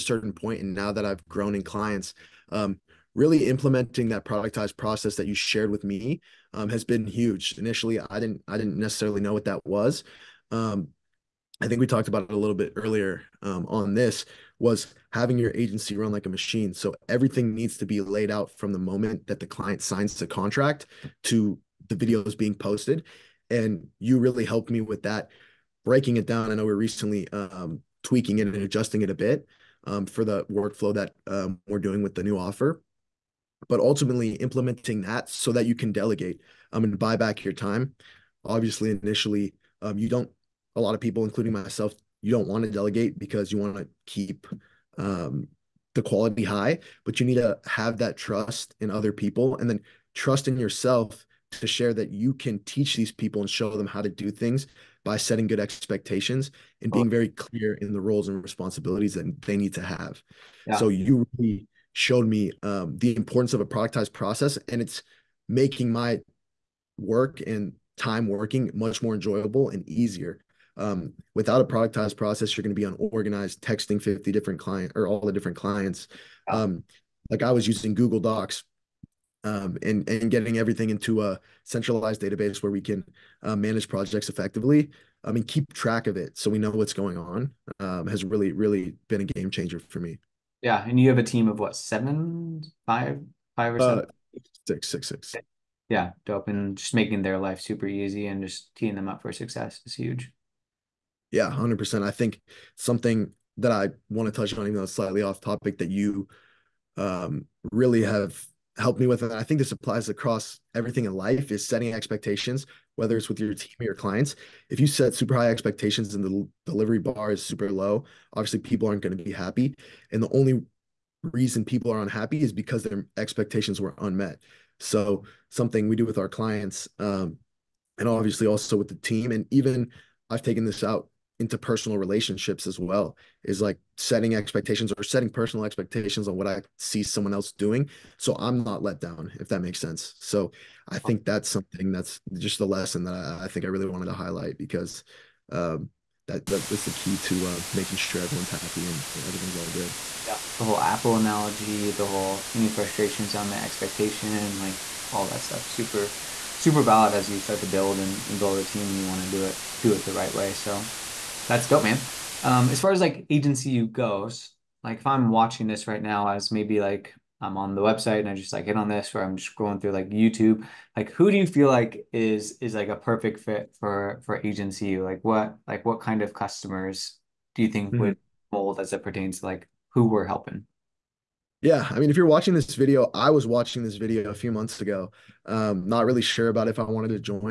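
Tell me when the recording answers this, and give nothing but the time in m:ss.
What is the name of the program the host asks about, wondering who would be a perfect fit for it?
2:43.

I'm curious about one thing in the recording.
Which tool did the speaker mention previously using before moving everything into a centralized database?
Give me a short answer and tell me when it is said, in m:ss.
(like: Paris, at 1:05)
Google Docs, at 1:17.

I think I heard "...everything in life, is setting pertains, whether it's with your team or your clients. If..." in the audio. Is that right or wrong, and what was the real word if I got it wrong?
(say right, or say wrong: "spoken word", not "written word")
wrong: "expectations", not "pertains".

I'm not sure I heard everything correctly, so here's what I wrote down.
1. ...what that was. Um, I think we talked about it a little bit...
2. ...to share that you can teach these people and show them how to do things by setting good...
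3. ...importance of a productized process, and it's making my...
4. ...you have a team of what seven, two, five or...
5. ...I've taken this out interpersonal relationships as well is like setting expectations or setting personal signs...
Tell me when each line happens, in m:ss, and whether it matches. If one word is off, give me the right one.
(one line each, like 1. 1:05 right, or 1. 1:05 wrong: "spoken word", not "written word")
1. 0:09 right
2. 0:51 right
3. 1:03 right
4. 1:30 wrong: "five", not "two"
5. 2:10 wrong: "expectations", not "signs".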